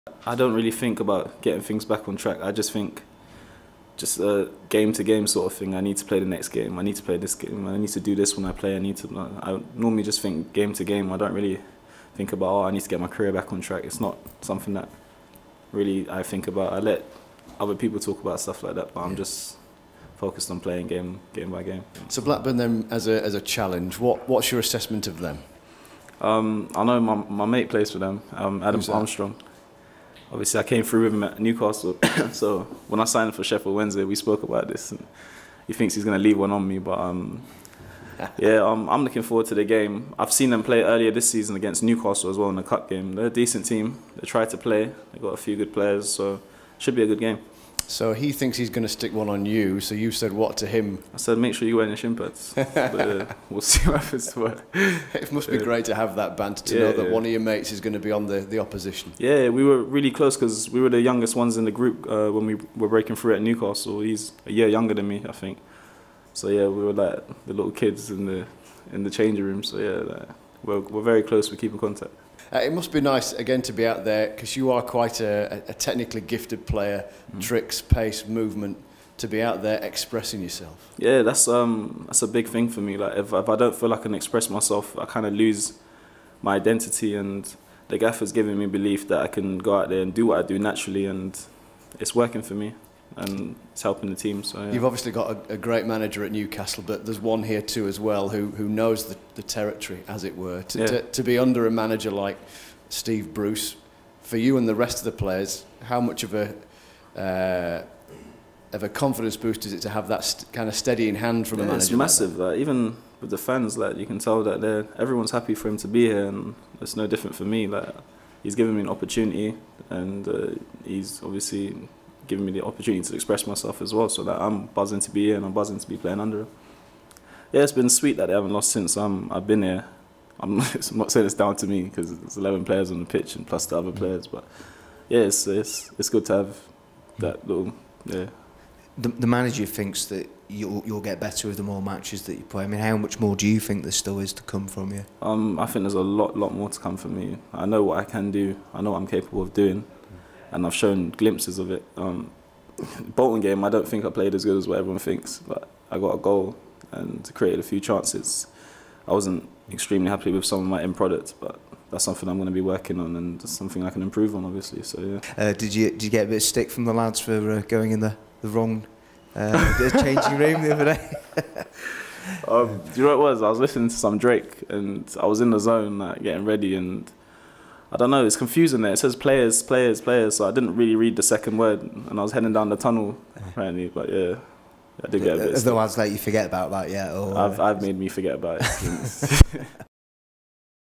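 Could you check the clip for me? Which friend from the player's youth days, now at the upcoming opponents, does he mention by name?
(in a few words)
Adam Armstrong.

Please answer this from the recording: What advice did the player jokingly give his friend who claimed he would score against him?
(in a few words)
Wear your shin pads.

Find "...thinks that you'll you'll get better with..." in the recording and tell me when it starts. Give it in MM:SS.
02:19.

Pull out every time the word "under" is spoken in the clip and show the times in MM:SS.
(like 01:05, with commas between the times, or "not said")
01:41, 02:06.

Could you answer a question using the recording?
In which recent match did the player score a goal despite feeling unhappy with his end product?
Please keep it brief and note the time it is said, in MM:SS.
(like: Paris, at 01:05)
Bolton, at 02:33.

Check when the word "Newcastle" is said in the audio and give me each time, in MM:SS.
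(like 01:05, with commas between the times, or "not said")
00:31, 00:41, 01:03, 01:36.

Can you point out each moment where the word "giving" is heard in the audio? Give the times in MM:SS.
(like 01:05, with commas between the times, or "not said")
01:28, 02:02.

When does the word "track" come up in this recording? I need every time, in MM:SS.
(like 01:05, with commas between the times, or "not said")
00:02, 00:13.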